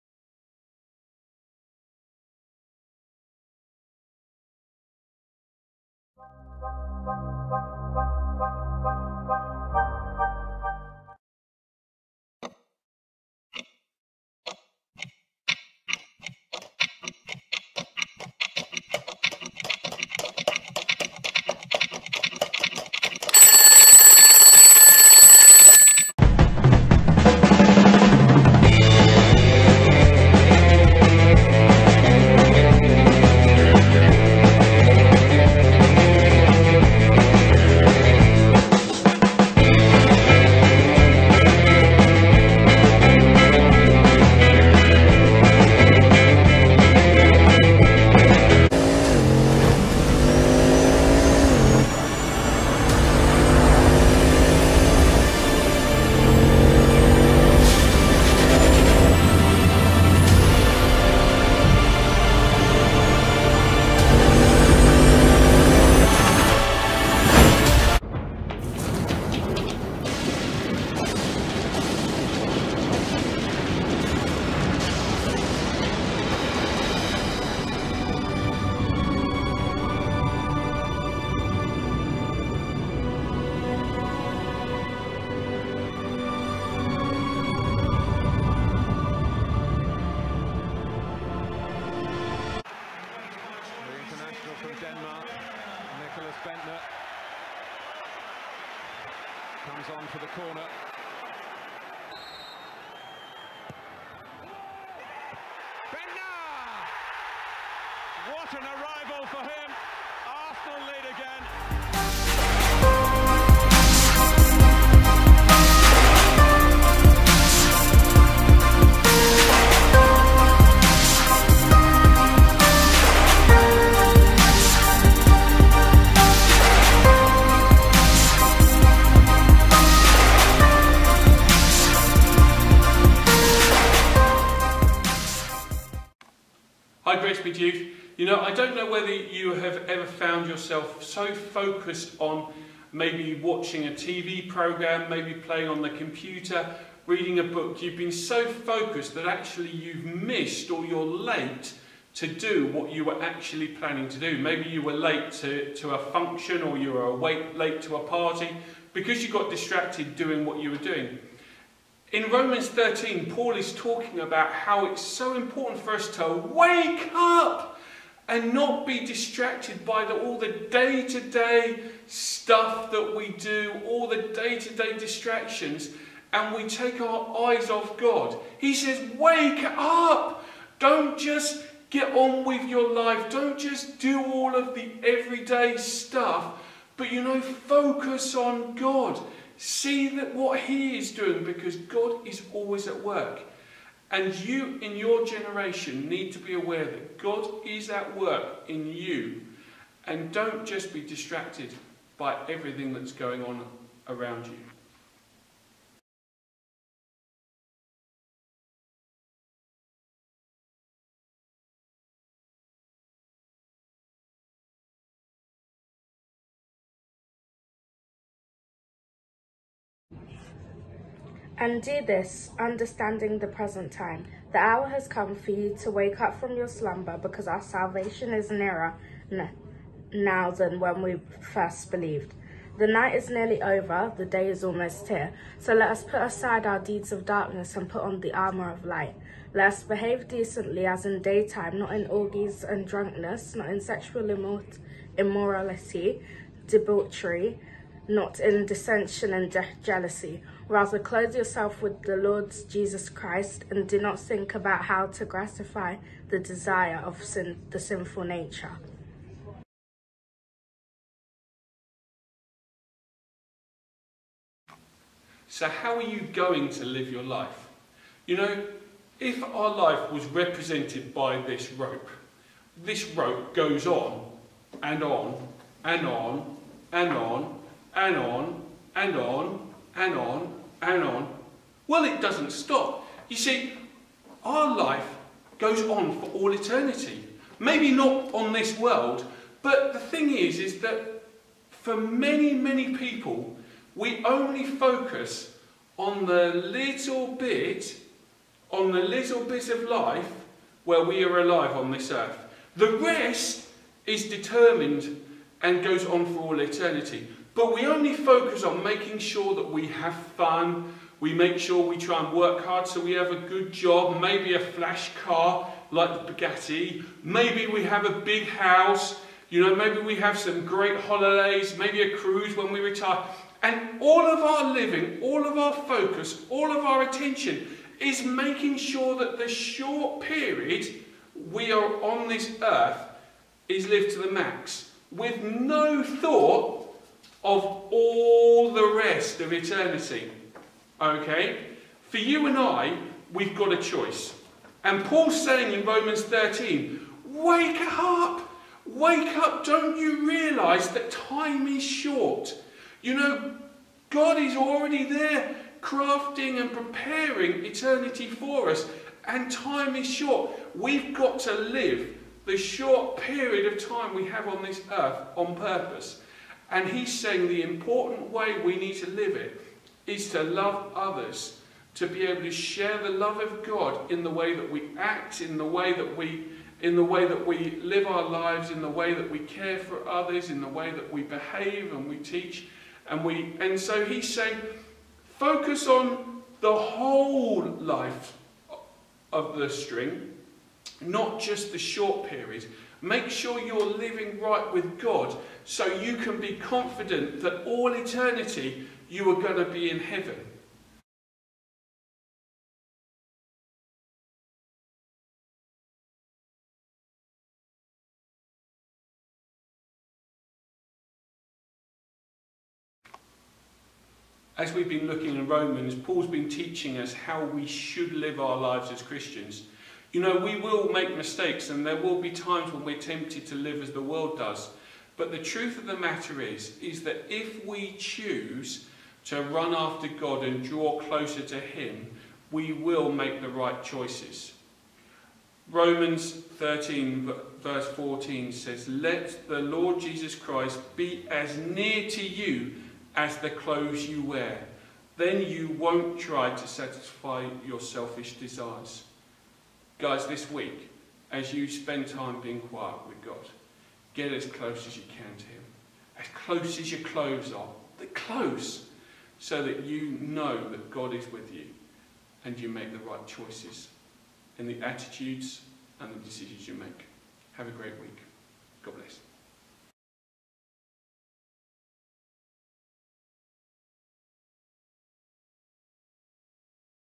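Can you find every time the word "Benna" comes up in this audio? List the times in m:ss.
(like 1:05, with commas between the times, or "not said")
1:45.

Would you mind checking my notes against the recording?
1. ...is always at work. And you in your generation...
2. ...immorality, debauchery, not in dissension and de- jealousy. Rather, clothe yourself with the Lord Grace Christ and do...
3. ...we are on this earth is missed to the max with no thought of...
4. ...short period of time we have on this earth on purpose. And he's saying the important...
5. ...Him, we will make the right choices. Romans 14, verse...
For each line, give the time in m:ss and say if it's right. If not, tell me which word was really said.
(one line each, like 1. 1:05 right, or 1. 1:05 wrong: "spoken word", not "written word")
1. 3:12 right
2. 4:05 wrong: "Jesus", not "Grace"
3. 5:31 wrong: "lived", not "missed"
4. 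6:02 right
5. 7:11 wrong: "13", not "14".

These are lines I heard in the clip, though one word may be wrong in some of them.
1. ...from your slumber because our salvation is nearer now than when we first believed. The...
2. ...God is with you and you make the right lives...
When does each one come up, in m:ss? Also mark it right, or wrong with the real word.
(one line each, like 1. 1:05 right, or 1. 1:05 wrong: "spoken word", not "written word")
1. 3:46 right
2. 7:40 wrong: "choices", not "lives".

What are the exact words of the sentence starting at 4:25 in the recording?
So, how are you going to live your life?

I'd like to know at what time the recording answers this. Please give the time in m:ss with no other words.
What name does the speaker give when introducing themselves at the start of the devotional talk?
2:17.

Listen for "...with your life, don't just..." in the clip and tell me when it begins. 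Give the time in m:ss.
3:02.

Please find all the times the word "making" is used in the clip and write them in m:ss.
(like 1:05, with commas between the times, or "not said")
5:08, 5:28.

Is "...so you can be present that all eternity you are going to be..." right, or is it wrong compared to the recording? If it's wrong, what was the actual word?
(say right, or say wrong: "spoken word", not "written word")
wrong: "confident", not "present".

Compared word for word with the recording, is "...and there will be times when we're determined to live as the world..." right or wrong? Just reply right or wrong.
wrong.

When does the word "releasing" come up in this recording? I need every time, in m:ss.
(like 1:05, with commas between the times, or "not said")
not said.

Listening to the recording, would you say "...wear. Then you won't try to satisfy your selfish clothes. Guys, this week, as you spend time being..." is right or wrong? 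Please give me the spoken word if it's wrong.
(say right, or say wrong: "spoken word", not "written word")
wrong: "desires", not "clothes".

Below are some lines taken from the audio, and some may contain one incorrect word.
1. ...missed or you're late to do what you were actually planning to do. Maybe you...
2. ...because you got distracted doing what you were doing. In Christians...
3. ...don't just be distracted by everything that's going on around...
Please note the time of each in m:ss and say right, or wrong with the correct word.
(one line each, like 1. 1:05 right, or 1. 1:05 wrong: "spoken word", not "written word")
1. 2:30 right
2. 2:38 wrong: "Romans", not "Christians"
3. 3:20 right.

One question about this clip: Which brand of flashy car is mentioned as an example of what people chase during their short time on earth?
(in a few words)
Bugatti.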